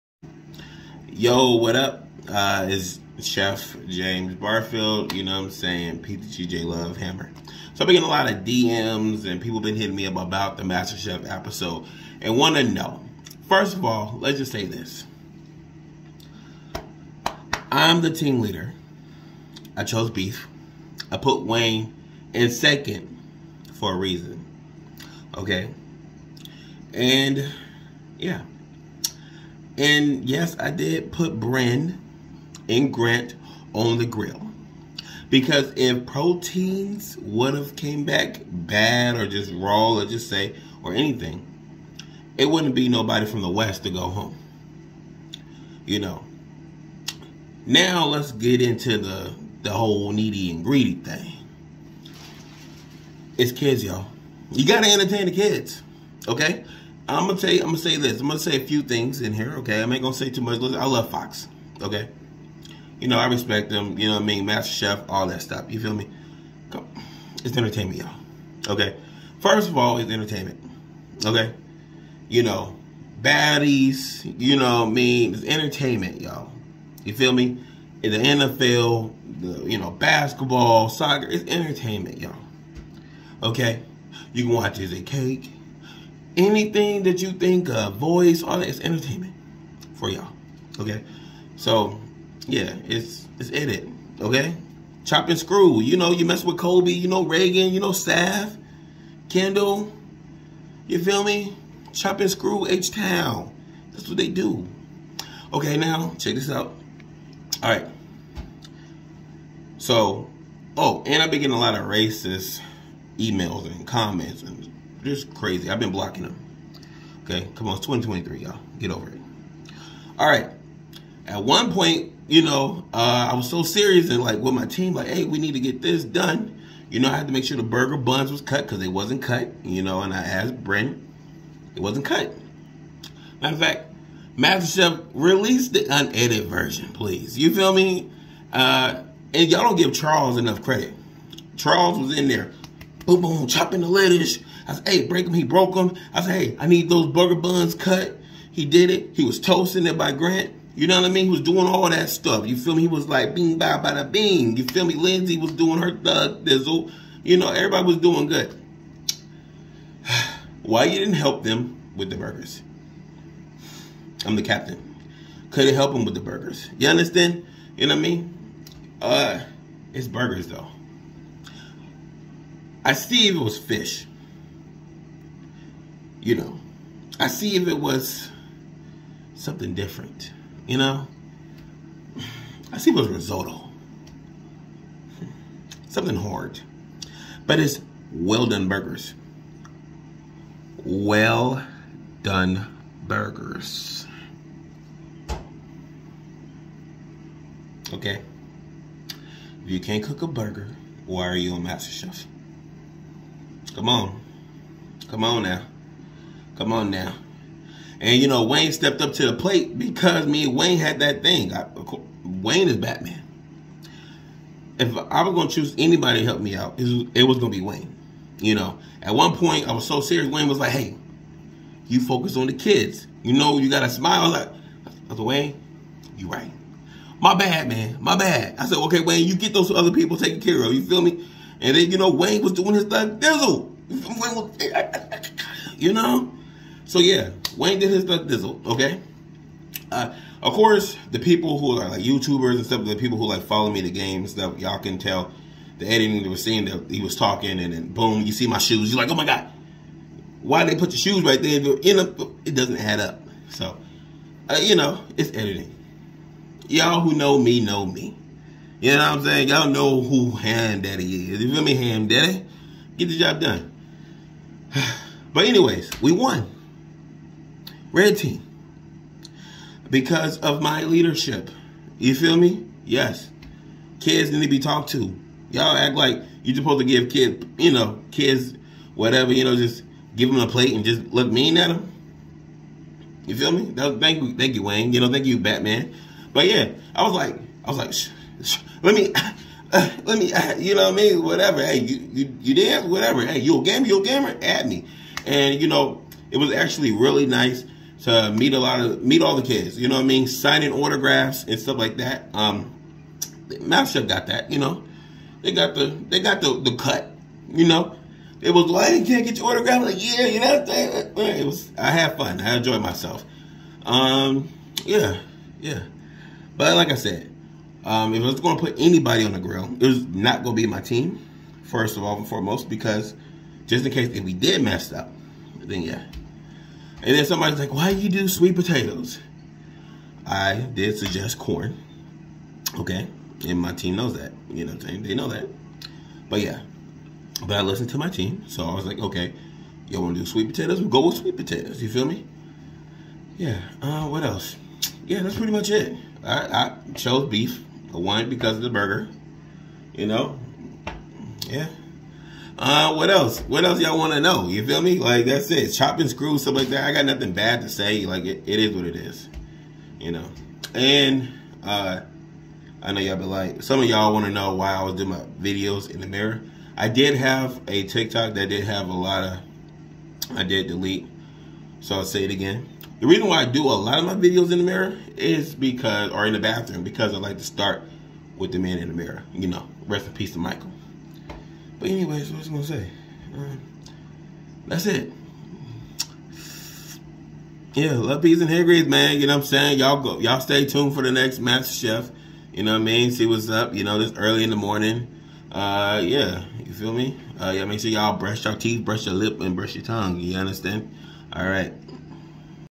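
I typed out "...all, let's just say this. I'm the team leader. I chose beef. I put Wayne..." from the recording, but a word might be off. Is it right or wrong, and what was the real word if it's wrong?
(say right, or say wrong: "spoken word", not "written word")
right.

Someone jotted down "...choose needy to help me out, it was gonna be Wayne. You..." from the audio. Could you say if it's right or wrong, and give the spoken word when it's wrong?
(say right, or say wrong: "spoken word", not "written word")
wrong: "anybody", not "needy".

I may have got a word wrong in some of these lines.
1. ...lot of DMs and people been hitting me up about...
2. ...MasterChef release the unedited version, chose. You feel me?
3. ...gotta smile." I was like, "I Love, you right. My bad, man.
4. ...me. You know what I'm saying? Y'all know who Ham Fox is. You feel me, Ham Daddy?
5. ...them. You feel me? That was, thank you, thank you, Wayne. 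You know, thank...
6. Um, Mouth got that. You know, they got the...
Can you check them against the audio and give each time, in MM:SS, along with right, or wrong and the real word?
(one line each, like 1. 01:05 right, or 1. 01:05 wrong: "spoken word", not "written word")
1. 00:08 right
2. 02:14 wrong: "please", not "chose"
3. 03:43 wrong: "Wayne", not "Love"
4. 04:17 wrong: "Daddy", not "Fox"
5. 04:41 right
6. 05:02 right.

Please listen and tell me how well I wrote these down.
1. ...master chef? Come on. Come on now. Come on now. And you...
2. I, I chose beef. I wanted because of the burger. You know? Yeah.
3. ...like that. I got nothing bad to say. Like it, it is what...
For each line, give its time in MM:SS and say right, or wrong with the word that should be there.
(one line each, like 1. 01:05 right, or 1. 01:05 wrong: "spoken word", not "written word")
1. 03:21 right
2. 05:46 right
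3. 05:56 right.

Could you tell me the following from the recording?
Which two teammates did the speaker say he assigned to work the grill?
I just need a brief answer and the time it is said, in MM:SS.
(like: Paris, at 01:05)
Bryan and Grant, at 00:31.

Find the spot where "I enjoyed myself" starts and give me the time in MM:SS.
05:12.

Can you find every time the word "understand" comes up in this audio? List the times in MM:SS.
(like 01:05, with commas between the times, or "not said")
02:46, 06:40.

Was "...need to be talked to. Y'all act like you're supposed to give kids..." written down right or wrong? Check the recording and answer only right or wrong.
right.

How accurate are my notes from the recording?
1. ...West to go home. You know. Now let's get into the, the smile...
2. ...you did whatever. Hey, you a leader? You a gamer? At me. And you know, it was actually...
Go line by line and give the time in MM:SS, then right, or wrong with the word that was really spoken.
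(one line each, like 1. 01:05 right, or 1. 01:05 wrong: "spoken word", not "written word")
1. 00:43 wrong: "whole", not "smile"
2. 04:52 wrong: "gamer", not "leader".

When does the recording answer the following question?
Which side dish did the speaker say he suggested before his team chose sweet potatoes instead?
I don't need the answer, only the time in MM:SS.
05:30.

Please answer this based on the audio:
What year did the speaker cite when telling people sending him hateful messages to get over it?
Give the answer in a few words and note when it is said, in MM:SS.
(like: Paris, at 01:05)
2023, at 01:57.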